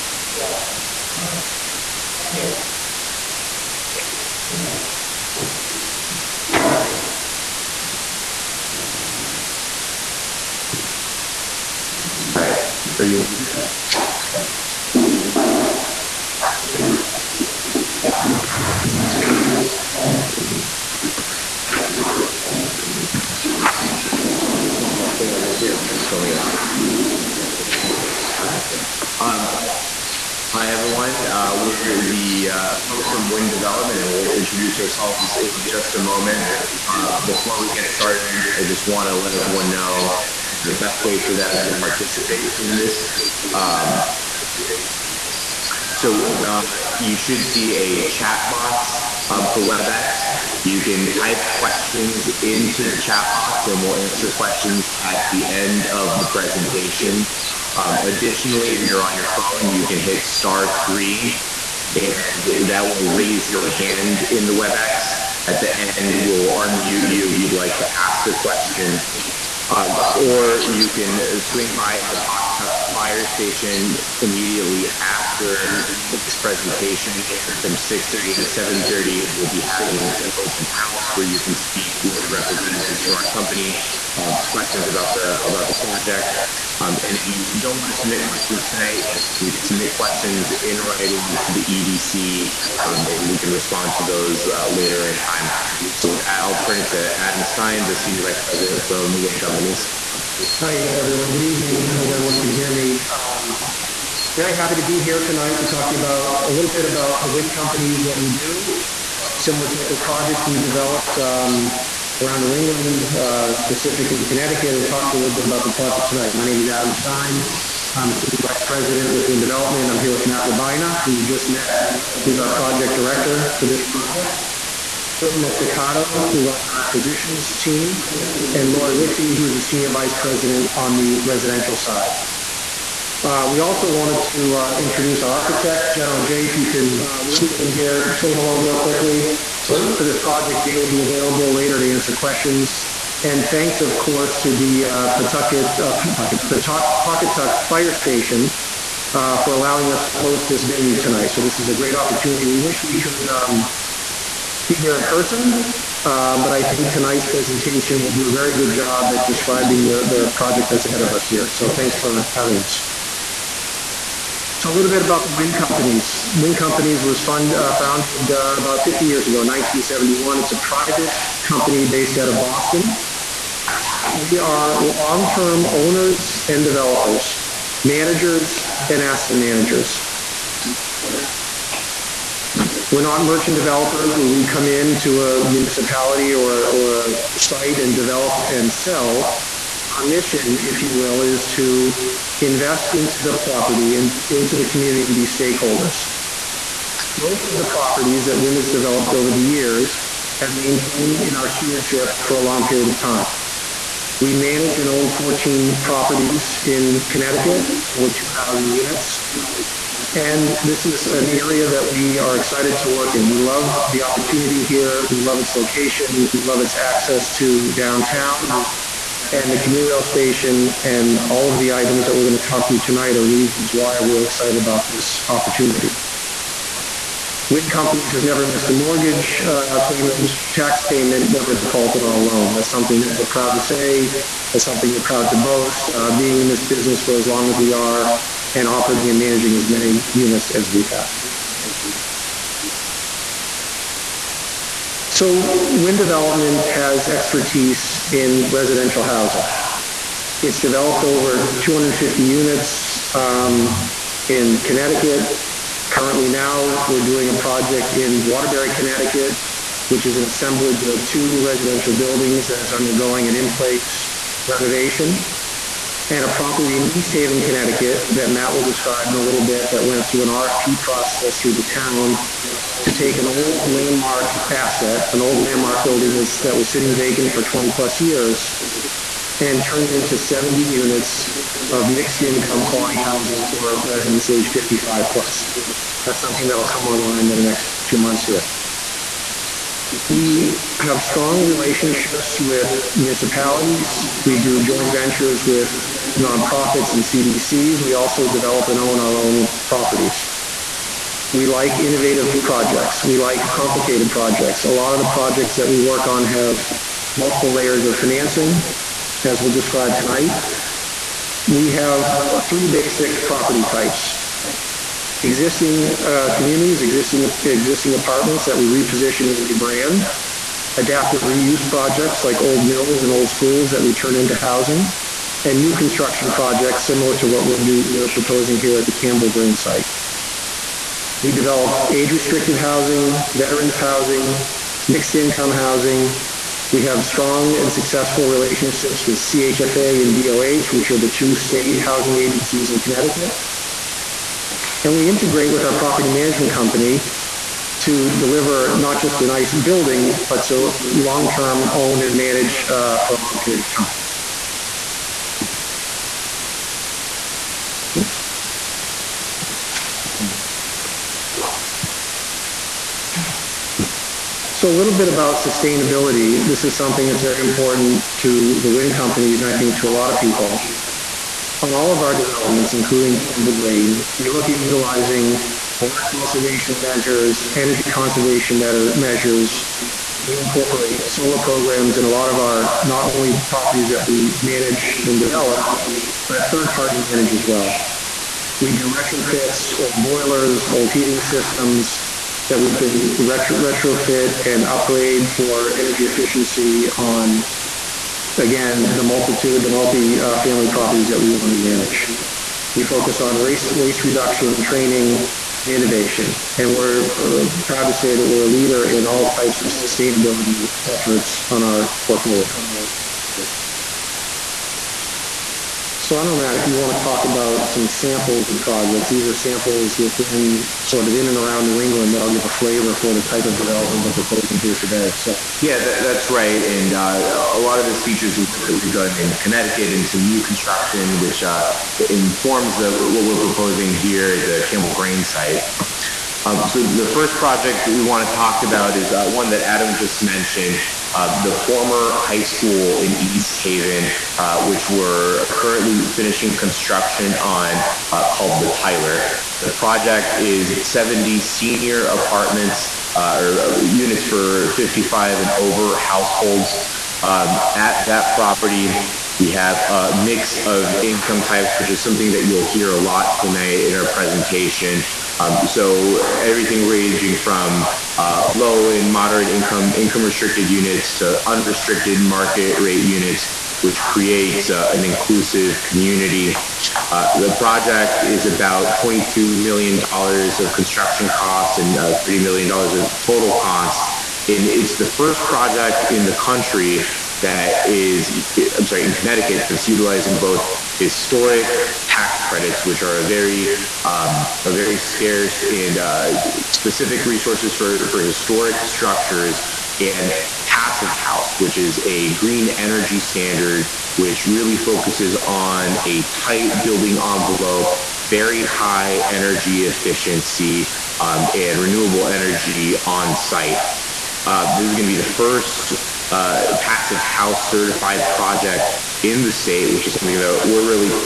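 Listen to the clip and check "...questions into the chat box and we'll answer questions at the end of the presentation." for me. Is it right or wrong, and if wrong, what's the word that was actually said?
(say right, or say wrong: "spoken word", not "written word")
right.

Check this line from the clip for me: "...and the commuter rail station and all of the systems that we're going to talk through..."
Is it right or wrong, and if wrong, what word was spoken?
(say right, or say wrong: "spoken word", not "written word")
wrong: "items", not "systems".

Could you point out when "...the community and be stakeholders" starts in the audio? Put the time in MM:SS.
03:14.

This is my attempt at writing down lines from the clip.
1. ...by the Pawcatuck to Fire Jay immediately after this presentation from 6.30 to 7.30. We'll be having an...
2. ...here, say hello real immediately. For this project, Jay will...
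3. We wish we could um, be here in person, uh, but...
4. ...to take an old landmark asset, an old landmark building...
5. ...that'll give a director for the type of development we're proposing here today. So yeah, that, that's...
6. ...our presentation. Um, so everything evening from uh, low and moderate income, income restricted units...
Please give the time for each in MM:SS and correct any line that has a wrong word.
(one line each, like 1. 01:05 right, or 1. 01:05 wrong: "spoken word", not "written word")
1. 01:11 wrong: "Station", not "Jay"
2. 02:17 wrong: "quickly", not "immediately"
3. 02:32 right
4. 04:32 right
5. 07:02 wrong: "flavor", not "director"
6. 07:43 wrong: "ranging", not "evening".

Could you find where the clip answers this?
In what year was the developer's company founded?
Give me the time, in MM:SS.
02:49.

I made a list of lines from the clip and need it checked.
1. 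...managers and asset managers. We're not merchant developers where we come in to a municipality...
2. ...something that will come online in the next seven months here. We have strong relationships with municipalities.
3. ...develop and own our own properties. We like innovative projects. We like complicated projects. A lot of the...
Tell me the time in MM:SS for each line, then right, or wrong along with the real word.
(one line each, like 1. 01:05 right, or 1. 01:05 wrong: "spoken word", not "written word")
1. 02:57 right
2. 04:46 wrong: "two", not "seven"
3. 04:58 right.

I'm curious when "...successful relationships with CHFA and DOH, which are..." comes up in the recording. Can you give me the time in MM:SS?
05:37.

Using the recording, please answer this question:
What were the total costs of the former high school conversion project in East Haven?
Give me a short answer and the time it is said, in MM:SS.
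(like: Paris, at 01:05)
$30 million, at 08:02.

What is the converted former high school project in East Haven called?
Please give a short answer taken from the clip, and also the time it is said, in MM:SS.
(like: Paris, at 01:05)
the Tyler, at 07:28.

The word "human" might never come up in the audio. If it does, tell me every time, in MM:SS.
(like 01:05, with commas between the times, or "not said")
not said.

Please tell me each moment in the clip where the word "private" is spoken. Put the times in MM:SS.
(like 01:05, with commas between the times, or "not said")
02:50.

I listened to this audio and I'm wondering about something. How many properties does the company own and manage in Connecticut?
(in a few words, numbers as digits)
14.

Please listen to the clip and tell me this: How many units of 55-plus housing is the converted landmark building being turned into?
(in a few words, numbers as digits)
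70.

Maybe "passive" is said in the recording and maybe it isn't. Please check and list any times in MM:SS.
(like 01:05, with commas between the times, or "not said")
08:20, 08:36.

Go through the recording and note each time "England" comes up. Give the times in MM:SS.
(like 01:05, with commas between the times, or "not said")
01:52, 07:01.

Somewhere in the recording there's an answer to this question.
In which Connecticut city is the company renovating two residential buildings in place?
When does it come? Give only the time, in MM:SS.
04:18.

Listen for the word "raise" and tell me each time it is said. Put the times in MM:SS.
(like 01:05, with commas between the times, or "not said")
01:03.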